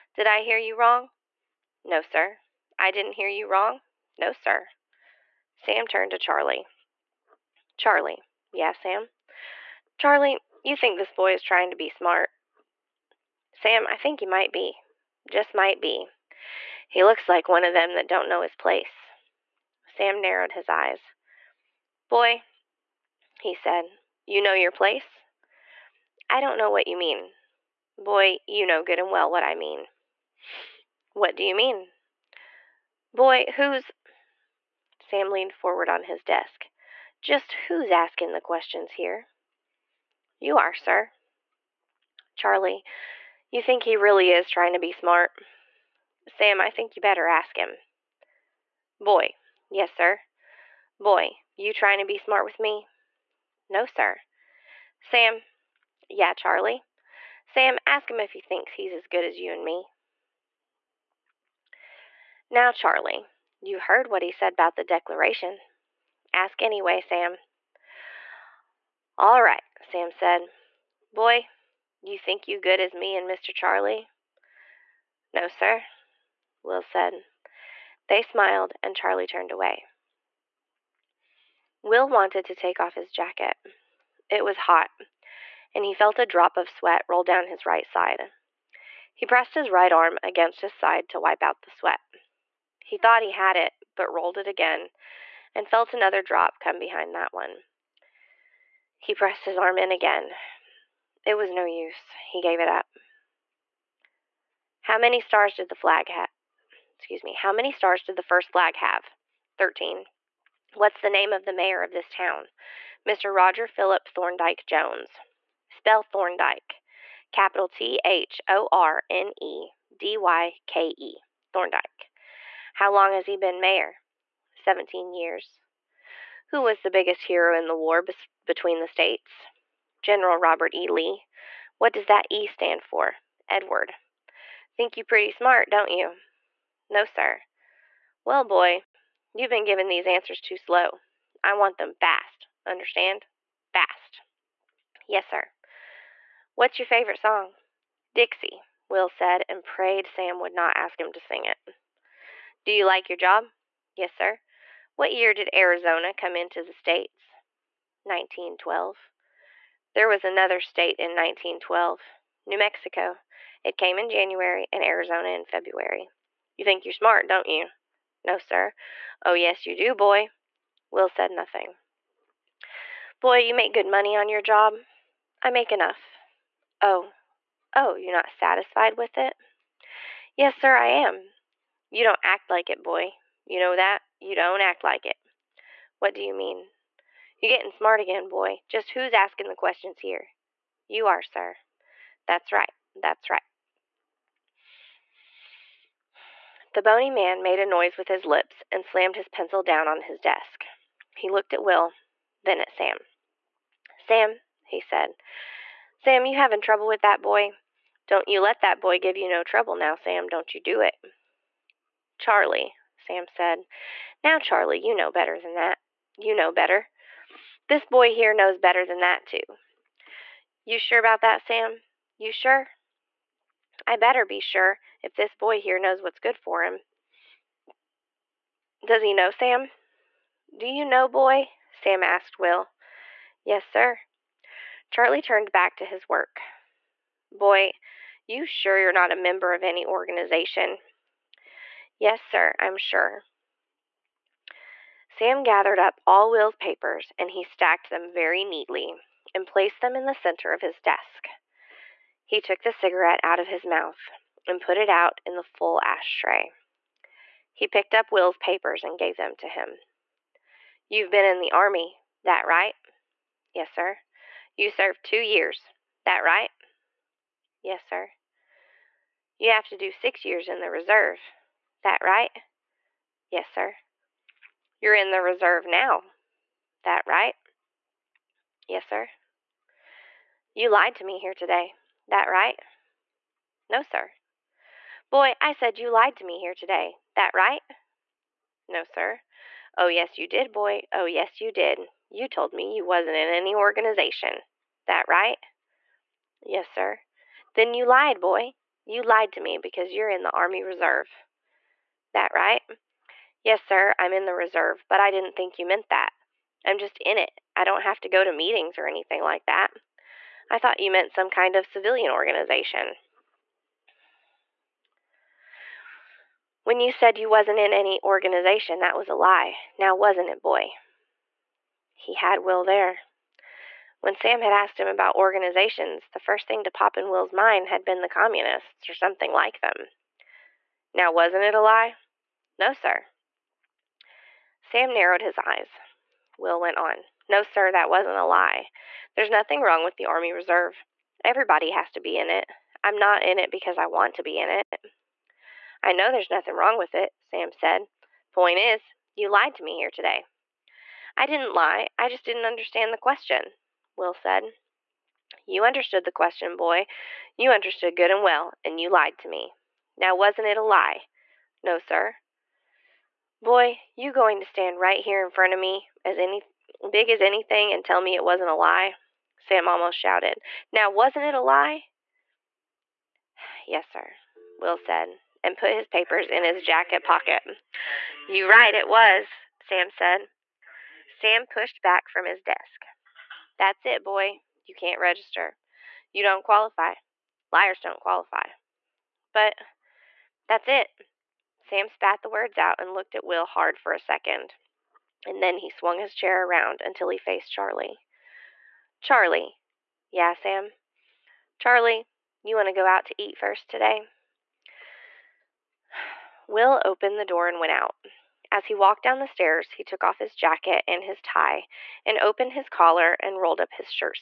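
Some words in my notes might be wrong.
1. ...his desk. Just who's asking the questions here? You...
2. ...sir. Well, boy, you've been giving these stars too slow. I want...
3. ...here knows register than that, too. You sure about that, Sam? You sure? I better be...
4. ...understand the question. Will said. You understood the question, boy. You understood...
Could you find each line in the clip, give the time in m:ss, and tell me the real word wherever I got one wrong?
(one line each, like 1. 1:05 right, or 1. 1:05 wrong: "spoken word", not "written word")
1. 0:36 right
2. 2:17 wrong: "answers", not "stars"
3. 3:38 wrong: "better", not "register"
4. 5:52 right.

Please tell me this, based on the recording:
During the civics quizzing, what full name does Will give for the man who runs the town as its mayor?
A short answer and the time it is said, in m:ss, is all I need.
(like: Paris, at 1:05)
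Roger Philip Thorndyke Jones, at 1:53.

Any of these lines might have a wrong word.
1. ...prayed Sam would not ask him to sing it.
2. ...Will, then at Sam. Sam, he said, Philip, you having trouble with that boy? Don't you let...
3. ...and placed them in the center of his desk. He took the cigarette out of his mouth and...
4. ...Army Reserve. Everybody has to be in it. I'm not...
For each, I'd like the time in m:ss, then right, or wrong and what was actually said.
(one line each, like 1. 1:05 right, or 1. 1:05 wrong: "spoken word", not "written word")
1. 2:29 right
2. 3:21 wrong: "Sam", not "Philip"
3. 4:09 right
4. 5:40 right.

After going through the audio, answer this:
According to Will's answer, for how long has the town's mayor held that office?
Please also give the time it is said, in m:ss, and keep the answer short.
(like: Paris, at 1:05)
17 years, at 2:04.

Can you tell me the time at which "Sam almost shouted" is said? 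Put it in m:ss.
6:09.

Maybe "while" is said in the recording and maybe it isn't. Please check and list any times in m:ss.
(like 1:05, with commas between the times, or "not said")
not said.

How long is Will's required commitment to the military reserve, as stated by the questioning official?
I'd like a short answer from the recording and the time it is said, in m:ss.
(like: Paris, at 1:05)
6 years, at 4:29.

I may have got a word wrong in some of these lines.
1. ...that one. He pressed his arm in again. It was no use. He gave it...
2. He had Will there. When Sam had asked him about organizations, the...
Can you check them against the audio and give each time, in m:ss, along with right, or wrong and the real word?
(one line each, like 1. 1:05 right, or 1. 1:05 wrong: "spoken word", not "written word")
1. 1:37 right
2. 5:21 right.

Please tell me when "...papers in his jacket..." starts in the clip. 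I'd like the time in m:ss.
6:15.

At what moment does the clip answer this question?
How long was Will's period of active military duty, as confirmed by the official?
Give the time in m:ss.
4:25.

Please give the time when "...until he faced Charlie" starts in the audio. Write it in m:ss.
6:36.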